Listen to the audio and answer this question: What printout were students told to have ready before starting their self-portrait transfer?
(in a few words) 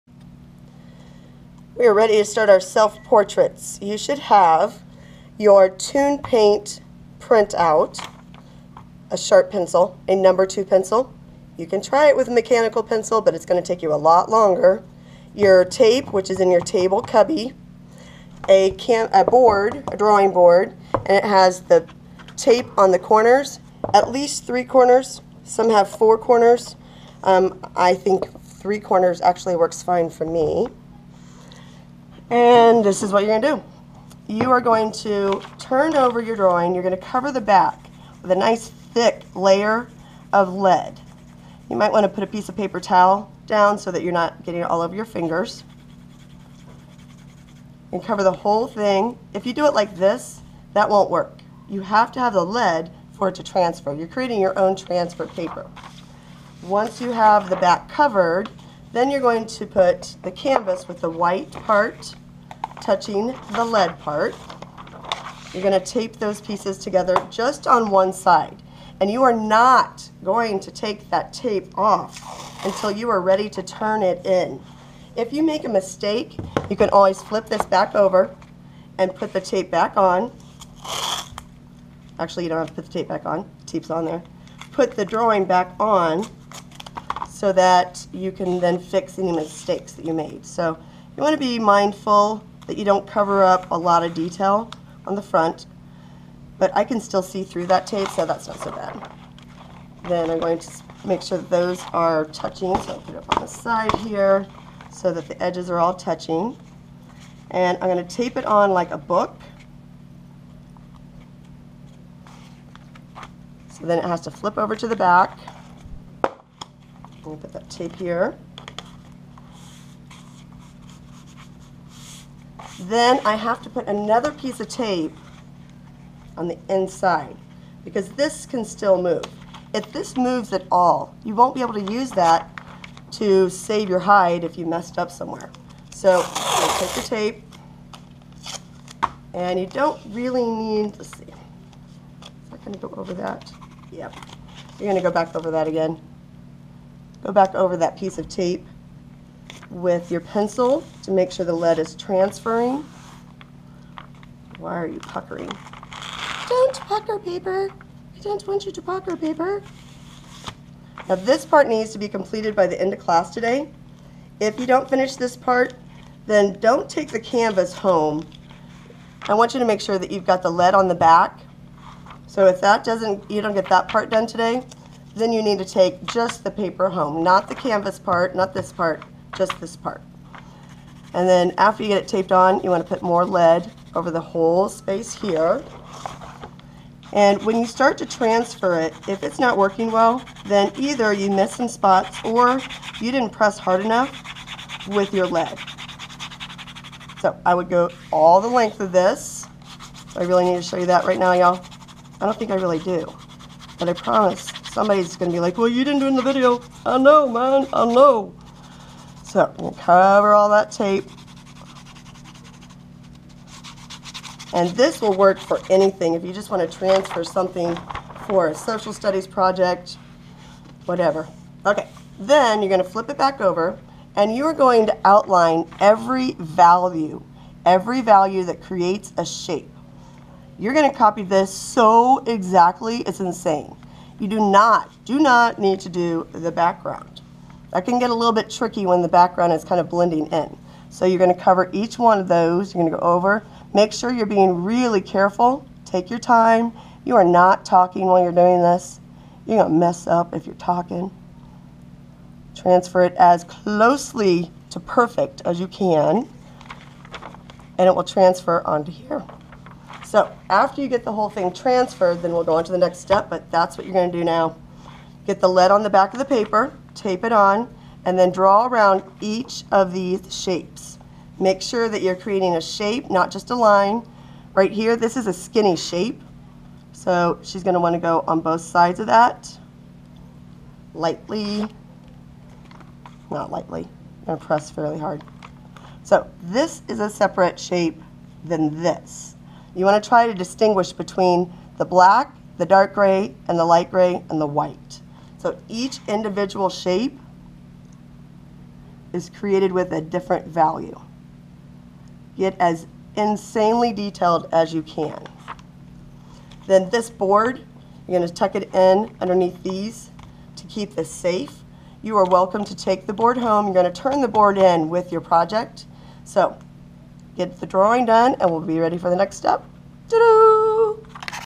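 ToonPaint.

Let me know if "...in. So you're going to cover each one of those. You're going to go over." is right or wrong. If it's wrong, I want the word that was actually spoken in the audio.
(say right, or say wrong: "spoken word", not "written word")
right.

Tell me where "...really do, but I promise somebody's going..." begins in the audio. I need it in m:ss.
3:22.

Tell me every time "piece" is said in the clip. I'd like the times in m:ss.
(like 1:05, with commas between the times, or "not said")
0:42, 1:06, 2:04, 2:27.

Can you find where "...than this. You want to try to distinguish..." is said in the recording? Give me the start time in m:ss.
4:48.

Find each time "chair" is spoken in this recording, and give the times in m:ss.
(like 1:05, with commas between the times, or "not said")
not said.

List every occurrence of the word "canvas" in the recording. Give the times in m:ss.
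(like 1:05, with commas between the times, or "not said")
1:00, 2:47, 2:57.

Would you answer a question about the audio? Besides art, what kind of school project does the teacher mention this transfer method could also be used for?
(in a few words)
social studies project.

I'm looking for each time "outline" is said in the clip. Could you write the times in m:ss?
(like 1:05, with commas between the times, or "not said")
3:45.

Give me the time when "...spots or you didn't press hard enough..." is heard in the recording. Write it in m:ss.
3:11.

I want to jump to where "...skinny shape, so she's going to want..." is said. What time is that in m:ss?
4:35.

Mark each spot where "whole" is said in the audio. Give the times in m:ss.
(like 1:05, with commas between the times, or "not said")
0:48, 3:04, 4:21.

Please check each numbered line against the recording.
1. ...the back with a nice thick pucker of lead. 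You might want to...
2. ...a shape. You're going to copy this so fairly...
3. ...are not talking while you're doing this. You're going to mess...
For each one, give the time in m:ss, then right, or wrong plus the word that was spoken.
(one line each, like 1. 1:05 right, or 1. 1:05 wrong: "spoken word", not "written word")
1. 0:37 wrong: "layer", not "pucker"
2. 3:49 wrong: "exactly", not "fairly"
3. 4:07 right.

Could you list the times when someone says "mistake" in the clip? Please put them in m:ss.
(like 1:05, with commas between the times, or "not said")
1:15, 1:29.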